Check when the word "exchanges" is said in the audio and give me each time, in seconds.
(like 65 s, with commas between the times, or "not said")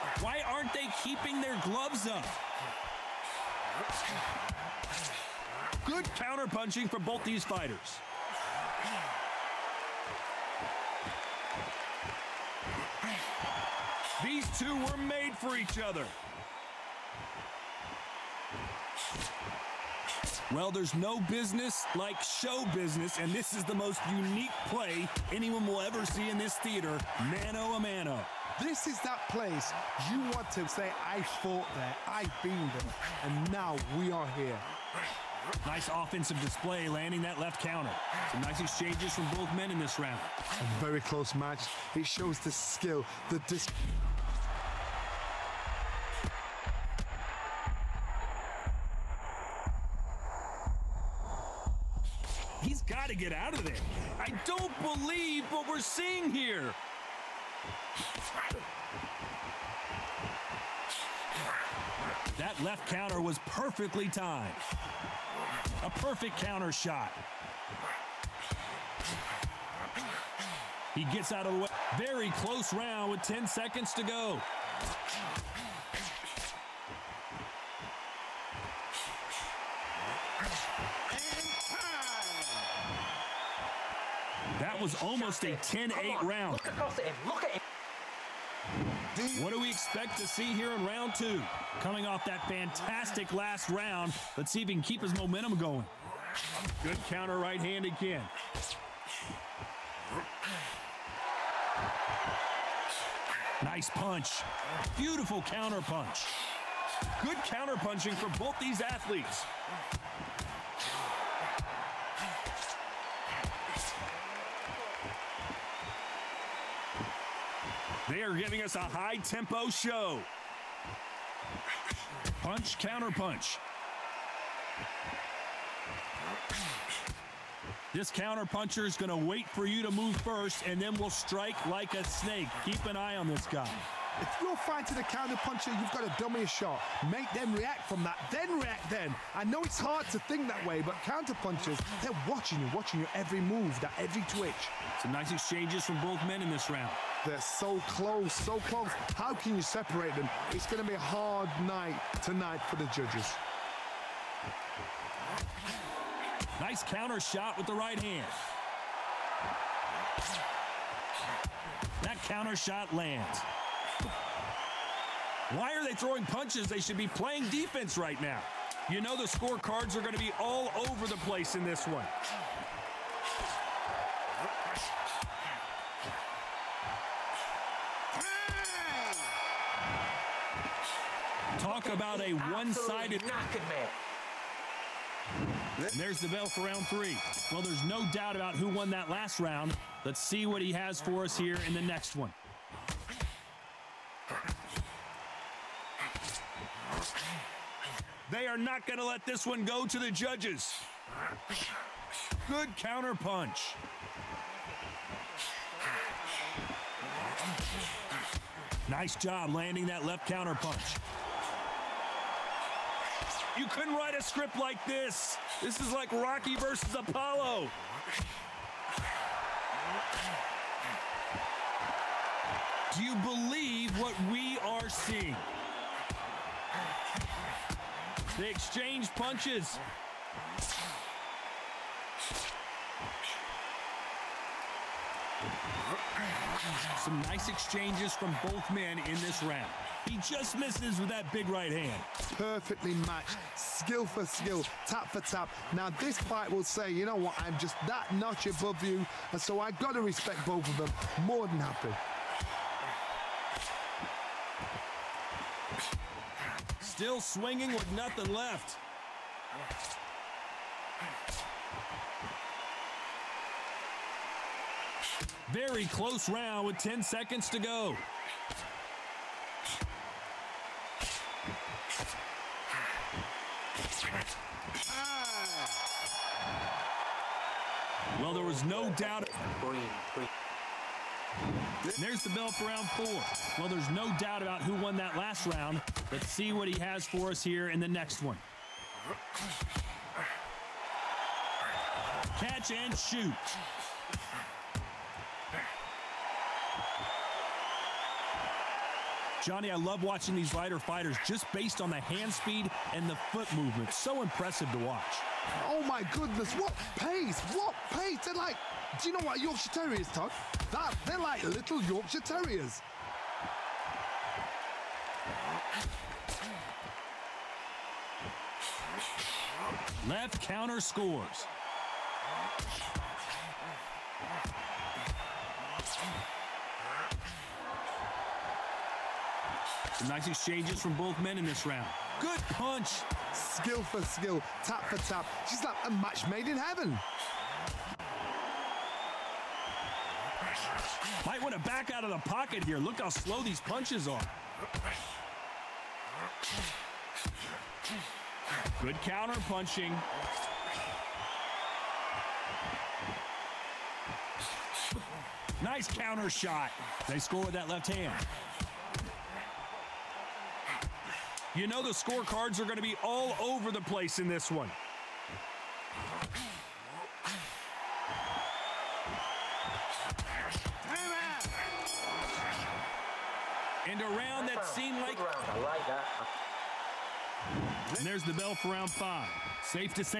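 38 s, 145 s, 228 s, 237 s, 330 s.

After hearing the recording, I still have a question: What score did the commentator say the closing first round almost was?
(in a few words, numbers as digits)
10-8.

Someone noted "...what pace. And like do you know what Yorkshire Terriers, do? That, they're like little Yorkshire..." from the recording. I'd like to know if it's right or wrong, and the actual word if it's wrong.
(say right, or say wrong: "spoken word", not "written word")
right.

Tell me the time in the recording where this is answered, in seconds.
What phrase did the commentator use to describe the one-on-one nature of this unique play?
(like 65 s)
27 s.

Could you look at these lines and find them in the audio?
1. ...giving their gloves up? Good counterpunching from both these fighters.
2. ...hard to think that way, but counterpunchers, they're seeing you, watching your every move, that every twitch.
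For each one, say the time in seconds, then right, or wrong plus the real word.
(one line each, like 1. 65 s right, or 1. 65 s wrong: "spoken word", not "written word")
1. 1 s wrong: "keeping", not "giving"
2. 139 s wrong: "watching", not "seeing".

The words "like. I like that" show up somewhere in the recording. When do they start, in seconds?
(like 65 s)
374 s.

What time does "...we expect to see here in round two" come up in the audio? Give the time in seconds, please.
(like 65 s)
89 s.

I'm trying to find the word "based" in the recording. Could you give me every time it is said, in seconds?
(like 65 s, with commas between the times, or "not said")
301 s.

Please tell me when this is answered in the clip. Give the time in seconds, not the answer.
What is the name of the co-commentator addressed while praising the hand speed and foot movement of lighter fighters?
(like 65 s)
299 s.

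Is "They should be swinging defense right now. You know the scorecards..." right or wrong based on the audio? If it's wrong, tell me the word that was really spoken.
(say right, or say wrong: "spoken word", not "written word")
wrong: "playing", not "swinging".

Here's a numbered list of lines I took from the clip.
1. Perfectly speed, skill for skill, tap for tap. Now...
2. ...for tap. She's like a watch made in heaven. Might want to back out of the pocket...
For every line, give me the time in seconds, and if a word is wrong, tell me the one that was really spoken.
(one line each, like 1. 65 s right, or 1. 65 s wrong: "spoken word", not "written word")
1. 242 s wrong: "matched", not "speed"
2. 334 s wrong: "match", not "watch".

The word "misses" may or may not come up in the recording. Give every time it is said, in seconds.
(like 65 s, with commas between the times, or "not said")
240 s.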